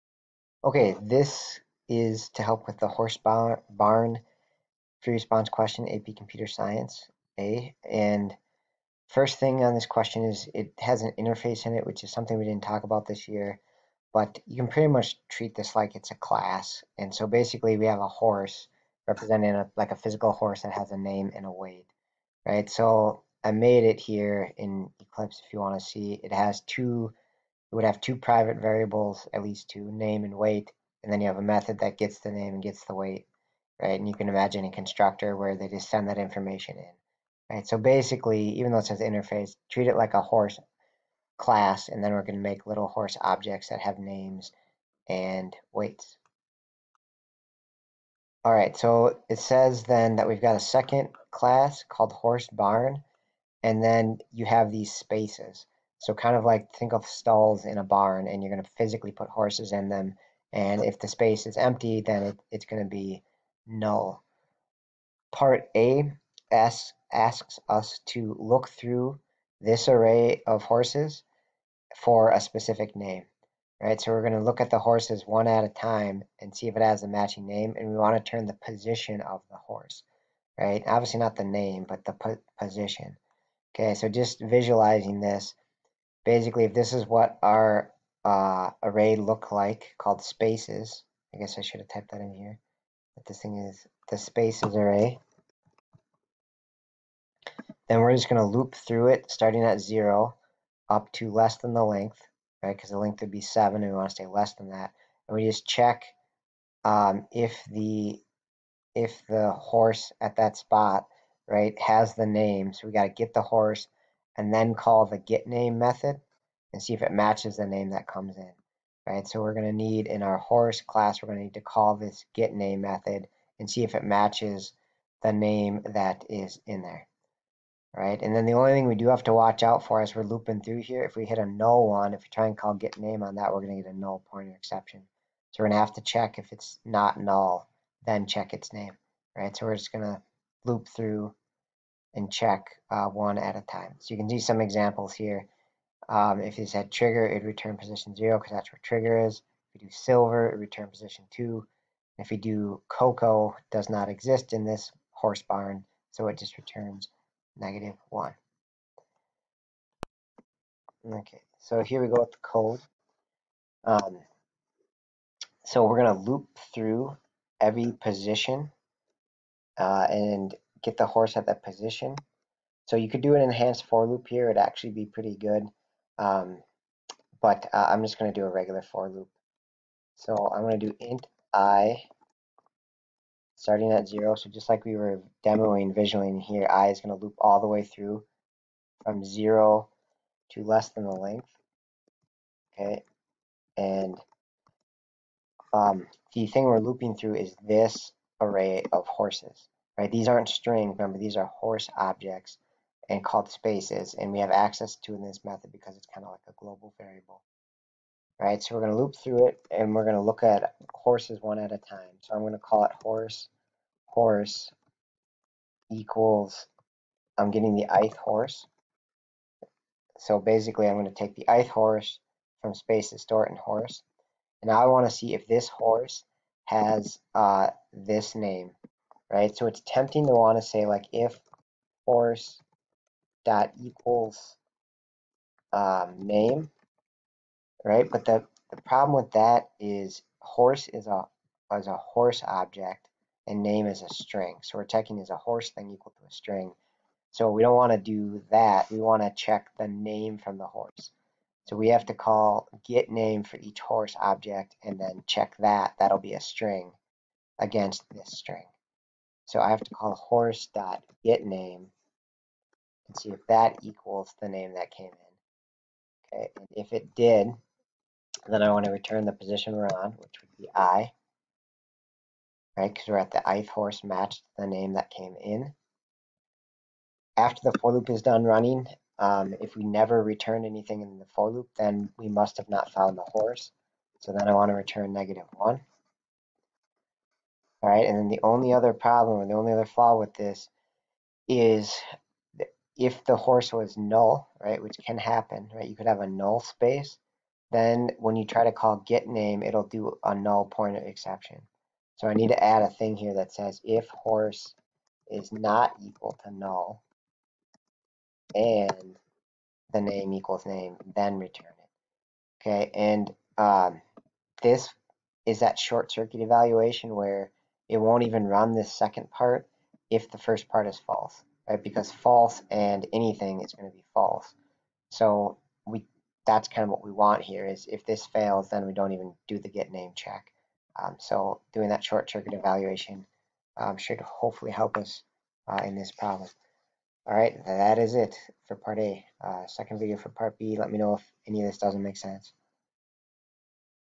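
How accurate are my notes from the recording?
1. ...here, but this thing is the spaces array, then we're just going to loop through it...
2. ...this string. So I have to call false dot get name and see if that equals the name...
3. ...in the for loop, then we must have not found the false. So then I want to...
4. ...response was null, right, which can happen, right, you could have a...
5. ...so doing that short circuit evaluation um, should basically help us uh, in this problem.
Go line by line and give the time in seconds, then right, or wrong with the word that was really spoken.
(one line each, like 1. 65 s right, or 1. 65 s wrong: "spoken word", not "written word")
1. 92 s right
2. 258 s wrong: "horse", not "false"
3. 281 s wrong: "horse", not "false"
4. 293 s wrong: "horse", not "response"
5. 331 s wrong: "hopefully", not "basically".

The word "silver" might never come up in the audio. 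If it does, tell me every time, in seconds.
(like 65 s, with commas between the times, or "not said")
149 s.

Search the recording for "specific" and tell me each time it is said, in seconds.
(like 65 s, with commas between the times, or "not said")
72 s.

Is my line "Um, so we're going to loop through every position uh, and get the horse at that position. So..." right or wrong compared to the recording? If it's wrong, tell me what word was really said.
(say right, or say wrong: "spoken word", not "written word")
right.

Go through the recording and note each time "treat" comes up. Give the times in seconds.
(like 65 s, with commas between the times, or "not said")
15 s, 39 s.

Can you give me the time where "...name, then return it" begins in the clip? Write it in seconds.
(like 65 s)
310 s.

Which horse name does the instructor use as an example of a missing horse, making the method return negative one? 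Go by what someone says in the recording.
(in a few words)
Cocoa.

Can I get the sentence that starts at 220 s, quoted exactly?
So basically, I'm going to take the ith horse from spaces, store it in horse.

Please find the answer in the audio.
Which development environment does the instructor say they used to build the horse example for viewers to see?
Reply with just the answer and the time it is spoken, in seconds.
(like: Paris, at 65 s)
Eclipse, at 24 s.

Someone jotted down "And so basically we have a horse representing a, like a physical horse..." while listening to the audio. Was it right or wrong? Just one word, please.
right.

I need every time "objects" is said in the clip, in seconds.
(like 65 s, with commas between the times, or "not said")
43 s, 201 s, 242 s, 254 s.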